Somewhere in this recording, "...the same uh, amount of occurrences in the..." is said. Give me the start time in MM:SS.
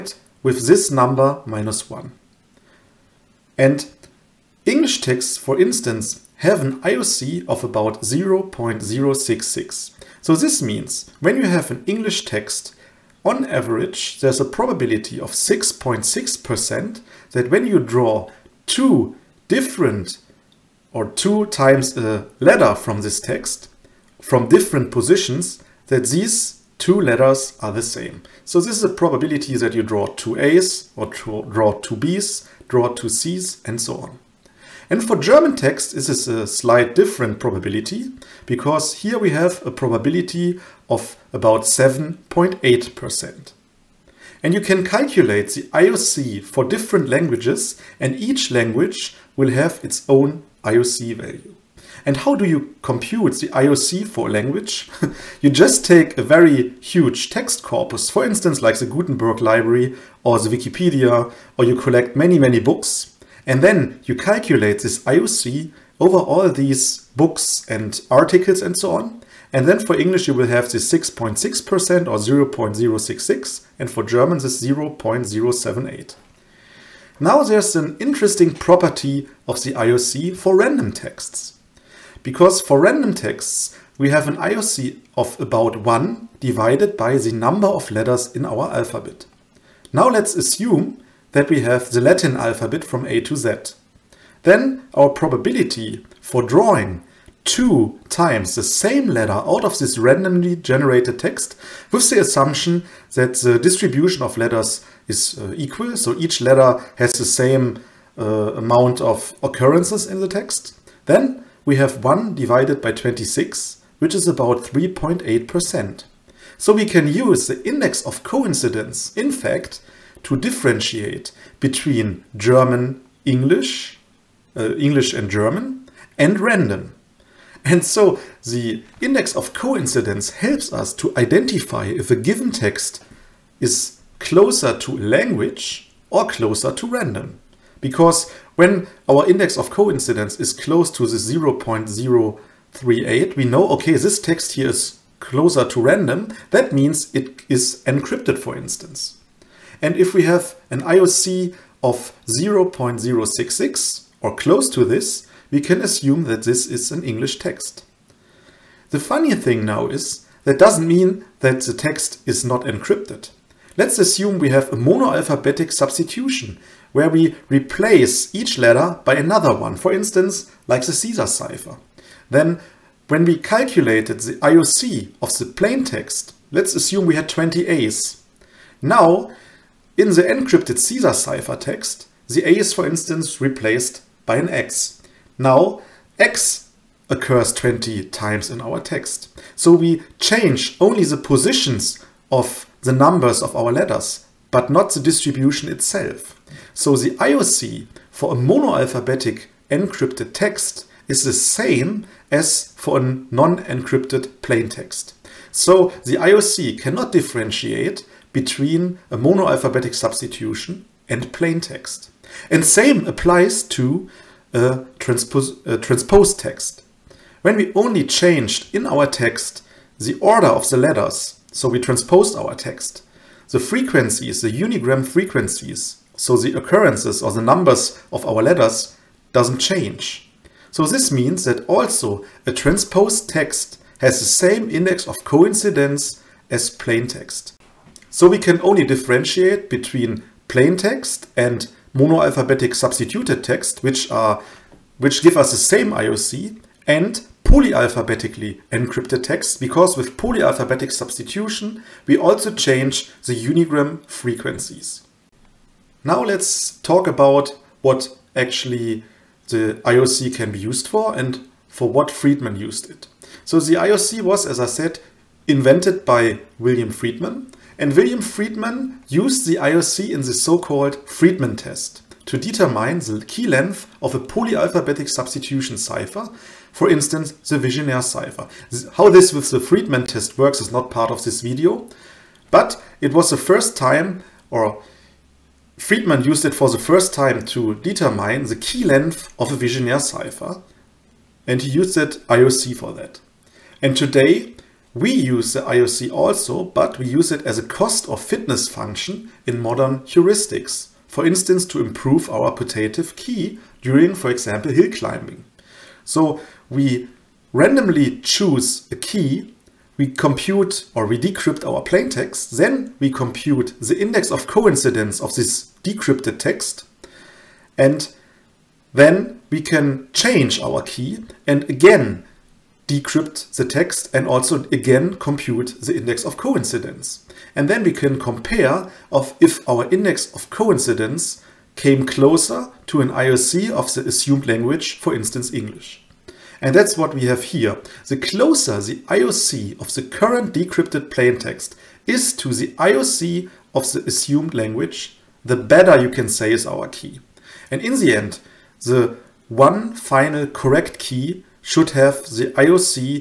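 01:47.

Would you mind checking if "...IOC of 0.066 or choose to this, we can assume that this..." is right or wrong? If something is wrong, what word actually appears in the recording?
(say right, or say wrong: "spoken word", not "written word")
wrong: "close", not "choose".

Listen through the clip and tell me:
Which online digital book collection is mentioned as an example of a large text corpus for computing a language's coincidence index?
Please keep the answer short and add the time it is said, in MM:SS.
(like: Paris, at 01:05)
Gutenberg library, at 00:58.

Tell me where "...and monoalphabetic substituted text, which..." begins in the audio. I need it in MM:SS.
04:01.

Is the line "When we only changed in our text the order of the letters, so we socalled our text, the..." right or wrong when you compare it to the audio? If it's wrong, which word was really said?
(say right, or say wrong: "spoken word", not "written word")
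wrong: "transposed", not "socalled".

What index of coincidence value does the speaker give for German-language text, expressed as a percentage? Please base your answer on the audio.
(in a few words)
7.8%.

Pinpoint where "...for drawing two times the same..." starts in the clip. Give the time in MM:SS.
01:36.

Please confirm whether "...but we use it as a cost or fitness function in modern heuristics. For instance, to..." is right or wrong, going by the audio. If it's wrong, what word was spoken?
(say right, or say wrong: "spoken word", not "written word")
right.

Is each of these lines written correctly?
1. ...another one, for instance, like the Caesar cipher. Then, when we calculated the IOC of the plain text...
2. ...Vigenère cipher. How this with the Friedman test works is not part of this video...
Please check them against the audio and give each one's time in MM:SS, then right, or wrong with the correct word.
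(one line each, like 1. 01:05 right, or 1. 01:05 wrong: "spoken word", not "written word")
1. 02:49 right
2. 04:37 right.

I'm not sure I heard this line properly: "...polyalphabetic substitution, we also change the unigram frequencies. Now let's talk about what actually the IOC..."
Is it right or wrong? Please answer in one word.
right.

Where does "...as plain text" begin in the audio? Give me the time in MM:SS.
03:56.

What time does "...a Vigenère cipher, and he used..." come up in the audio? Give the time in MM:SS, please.
04:49.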